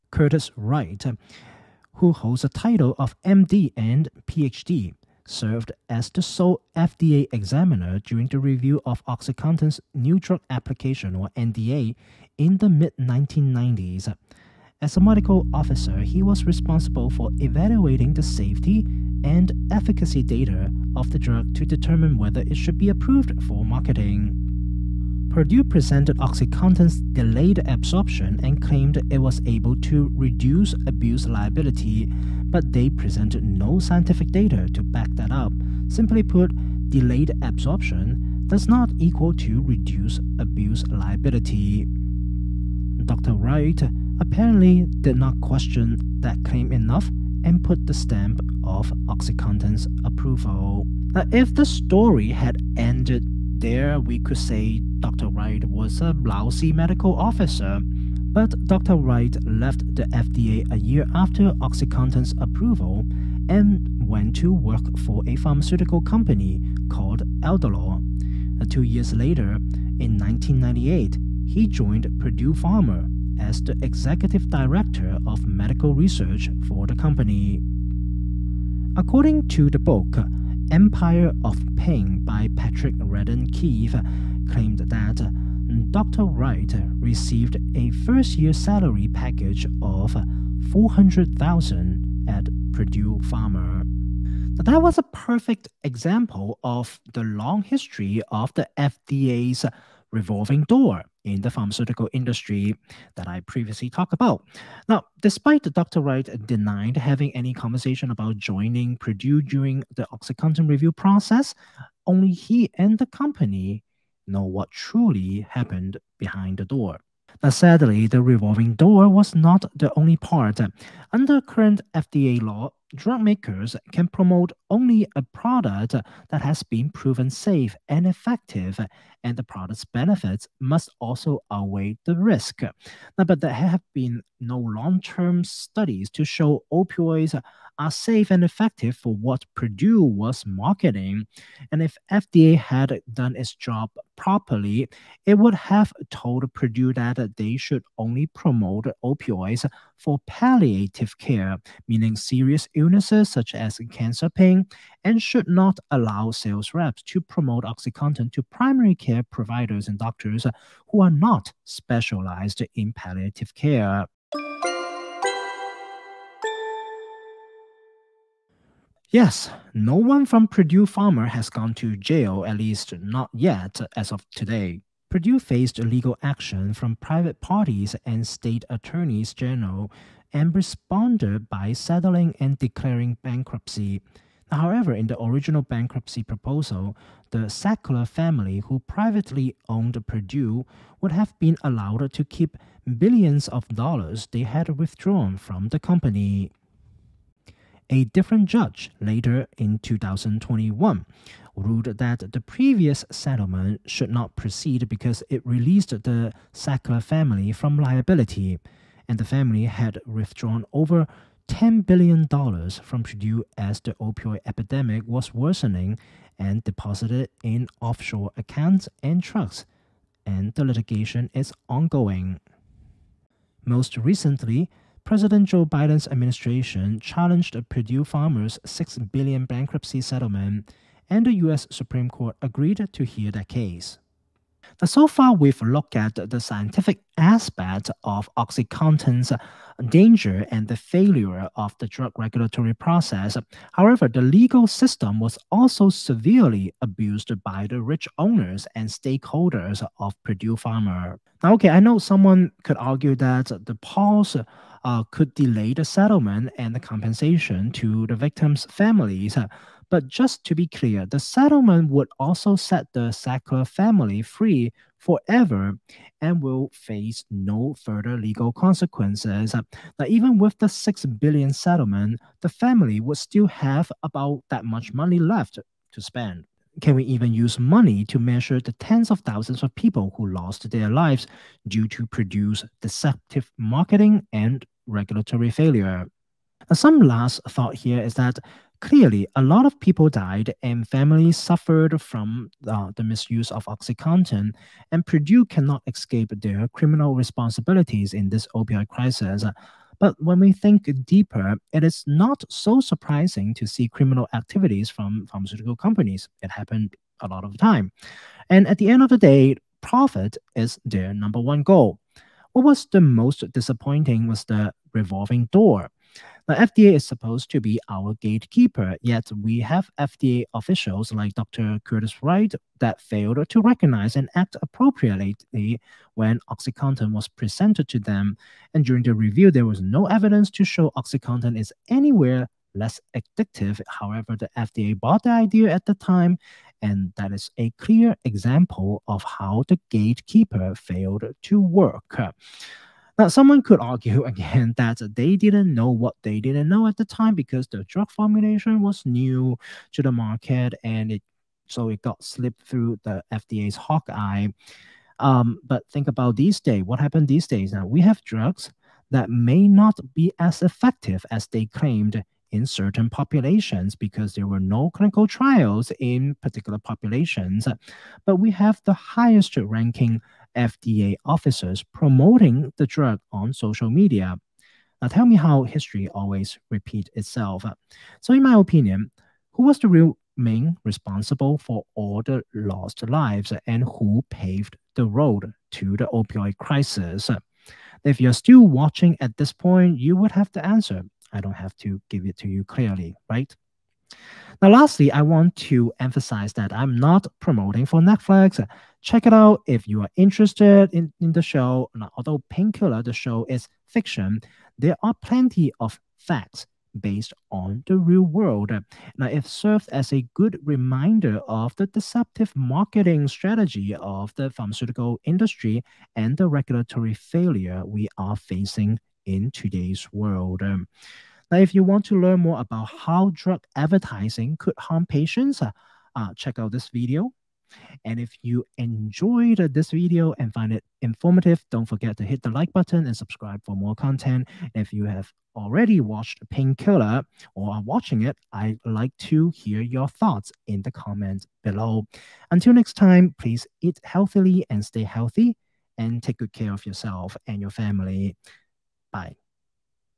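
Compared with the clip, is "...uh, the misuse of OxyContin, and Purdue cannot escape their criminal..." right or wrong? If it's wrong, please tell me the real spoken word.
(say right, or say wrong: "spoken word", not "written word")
right.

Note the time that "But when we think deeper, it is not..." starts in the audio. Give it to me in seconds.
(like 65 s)
299 s.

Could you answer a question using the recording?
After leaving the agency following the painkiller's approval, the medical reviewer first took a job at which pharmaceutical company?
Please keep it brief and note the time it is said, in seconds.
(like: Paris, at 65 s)
Adolor, at 67 s.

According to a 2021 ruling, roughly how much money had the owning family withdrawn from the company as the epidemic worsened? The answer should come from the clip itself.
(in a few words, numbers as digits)
over $10 billion.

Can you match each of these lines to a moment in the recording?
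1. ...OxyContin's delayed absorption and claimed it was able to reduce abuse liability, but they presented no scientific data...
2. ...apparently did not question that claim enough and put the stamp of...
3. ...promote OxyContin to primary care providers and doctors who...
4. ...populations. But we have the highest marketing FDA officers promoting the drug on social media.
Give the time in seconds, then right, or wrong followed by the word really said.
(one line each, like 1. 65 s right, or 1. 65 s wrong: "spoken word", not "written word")
1. 26 s right
2. 44 s right
3. 157 s right
4. 366 s wrong: "ranking", not "marketing".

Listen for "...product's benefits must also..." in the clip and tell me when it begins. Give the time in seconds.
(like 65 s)
129 s.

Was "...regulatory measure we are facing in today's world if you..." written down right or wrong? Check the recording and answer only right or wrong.
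wrong.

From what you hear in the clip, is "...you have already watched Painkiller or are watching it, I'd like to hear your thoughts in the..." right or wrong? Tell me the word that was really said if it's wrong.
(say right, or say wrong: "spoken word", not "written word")
right.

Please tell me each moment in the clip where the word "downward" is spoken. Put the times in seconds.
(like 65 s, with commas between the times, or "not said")
not said.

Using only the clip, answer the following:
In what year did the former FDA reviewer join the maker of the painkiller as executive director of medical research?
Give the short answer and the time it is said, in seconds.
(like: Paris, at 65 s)
1998, at 70 s.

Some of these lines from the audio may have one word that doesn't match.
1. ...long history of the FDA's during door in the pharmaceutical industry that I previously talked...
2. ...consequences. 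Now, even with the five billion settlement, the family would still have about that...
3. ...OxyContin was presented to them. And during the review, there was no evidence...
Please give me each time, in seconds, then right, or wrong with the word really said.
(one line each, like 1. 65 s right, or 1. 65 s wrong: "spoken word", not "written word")
1. 97 s wrong: "revolving", not "during"
2. 268 s wrong: "six", not "five"
3. 326 s right.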